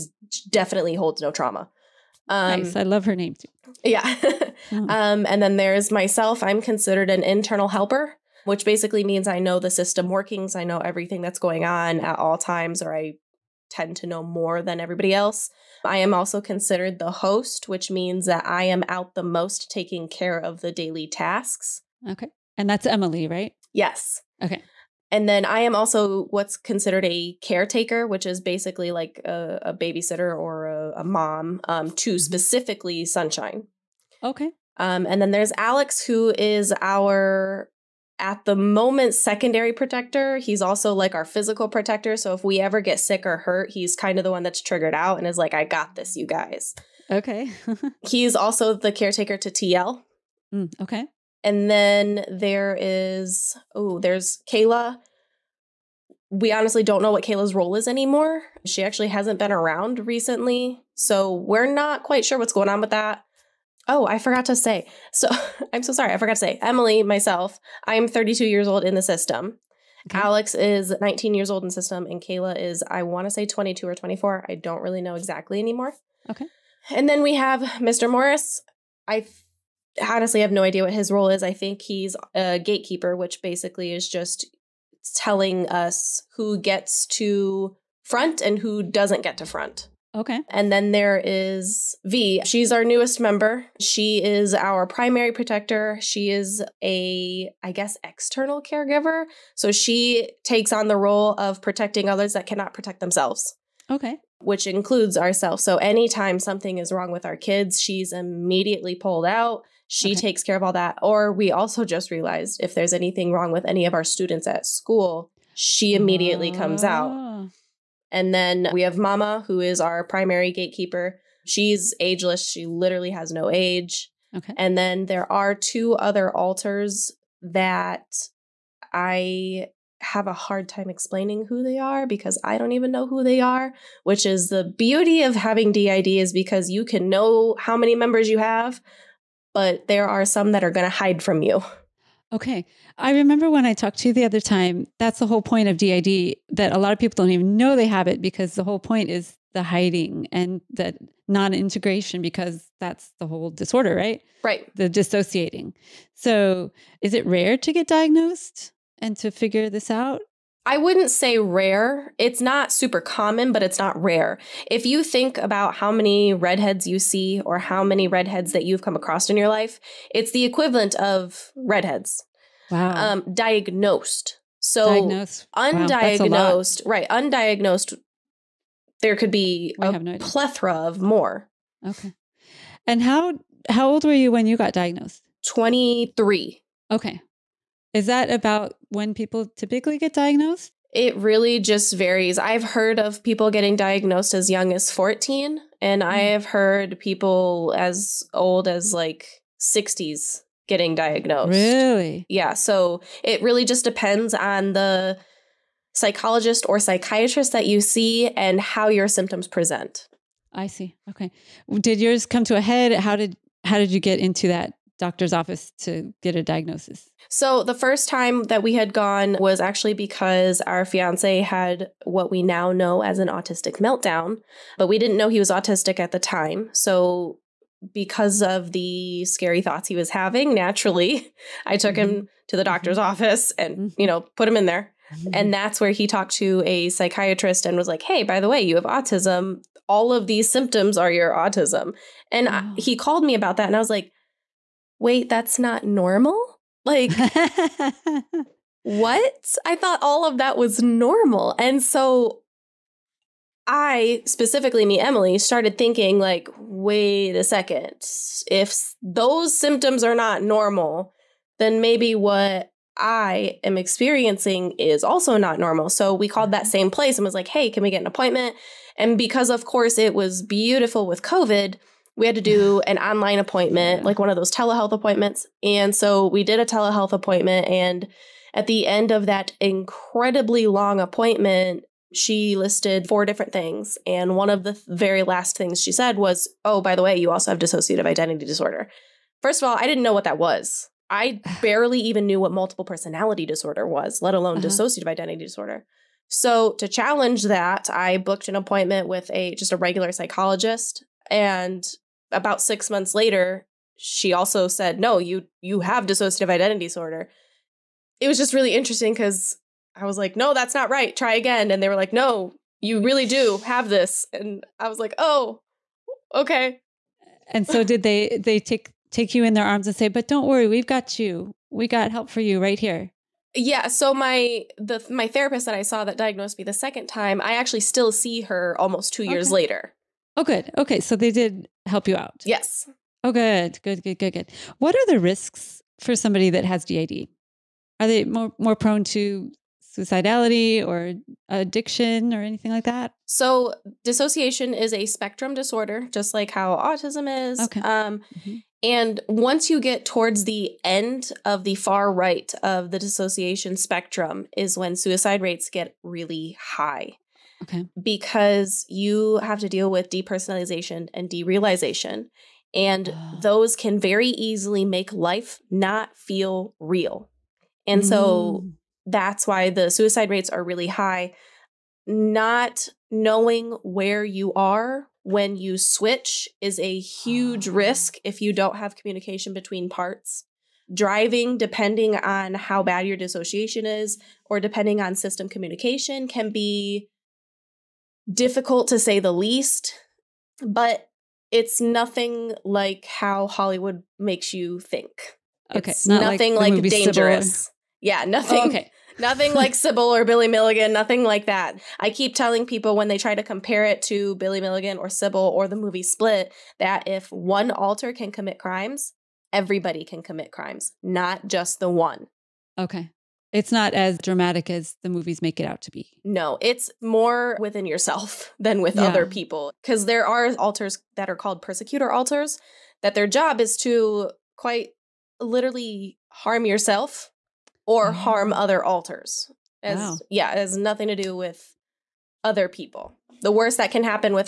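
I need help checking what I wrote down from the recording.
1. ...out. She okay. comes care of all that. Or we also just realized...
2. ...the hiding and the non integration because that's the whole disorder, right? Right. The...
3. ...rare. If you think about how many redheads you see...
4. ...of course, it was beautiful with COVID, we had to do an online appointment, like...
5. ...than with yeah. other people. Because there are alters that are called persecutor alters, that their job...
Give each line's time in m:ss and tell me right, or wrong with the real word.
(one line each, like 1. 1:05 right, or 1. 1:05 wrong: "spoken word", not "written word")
1. 1:49 wrong: "takes", not "comes"
2. 2:29 right
3. 2:44 right
4. 4:29 right
5. 6:58 right.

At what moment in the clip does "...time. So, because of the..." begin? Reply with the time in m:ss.
3:46.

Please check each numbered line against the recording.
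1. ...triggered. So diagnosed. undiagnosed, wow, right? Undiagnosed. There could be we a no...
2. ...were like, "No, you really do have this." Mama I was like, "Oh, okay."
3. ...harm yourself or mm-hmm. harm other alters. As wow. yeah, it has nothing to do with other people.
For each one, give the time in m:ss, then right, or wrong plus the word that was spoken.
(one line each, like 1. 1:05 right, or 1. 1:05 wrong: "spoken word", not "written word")
1. 2:53 wrong: "diagnosed", not "triggered"
2. 5:11 wrong: "And", not "Mama"
3. 7:06 right.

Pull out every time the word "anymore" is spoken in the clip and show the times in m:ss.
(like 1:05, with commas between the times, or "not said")
0:57, 1:15.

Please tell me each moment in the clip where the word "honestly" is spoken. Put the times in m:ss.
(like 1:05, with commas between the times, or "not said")
0:56, 1:20.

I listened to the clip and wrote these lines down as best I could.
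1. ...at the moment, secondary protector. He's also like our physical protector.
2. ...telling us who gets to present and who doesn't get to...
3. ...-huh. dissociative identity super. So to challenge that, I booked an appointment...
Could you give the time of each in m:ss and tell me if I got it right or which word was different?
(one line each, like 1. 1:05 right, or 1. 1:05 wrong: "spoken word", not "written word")
1. 0:38 right
2. 1:25 wrong: "front", not "present"
3. 4:54 wrong: "disorder", not "super".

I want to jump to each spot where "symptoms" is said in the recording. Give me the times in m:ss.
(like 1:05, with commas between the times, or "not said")
3:29, 4:00, 4:19.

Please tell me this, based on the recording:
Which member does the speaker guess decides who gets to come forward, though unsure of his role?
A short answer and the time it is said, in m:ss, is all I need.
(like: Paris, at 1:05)
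Mr. Morris, at 1:17.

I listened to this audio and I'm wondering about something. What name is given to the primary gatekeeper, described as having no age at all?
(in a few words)
Mama.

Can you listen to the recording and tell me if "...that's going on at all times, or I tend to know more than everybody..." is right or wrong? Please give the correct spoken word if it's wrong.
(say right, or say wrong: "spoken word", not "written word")
right.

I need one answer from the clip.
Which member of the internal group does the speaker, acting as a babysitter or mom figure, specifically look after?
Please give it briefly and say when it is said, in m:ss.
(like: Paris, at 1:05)
Sunshine, at 0:33.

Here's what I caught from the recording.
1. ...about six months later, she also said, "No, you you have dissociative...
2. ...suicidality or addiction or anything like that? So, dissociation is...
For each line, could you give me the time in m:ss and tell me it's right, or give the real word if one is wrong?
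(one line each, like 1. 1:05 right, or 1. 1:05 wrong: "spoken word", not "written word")
1. 5:02 right
2. 5:39 right.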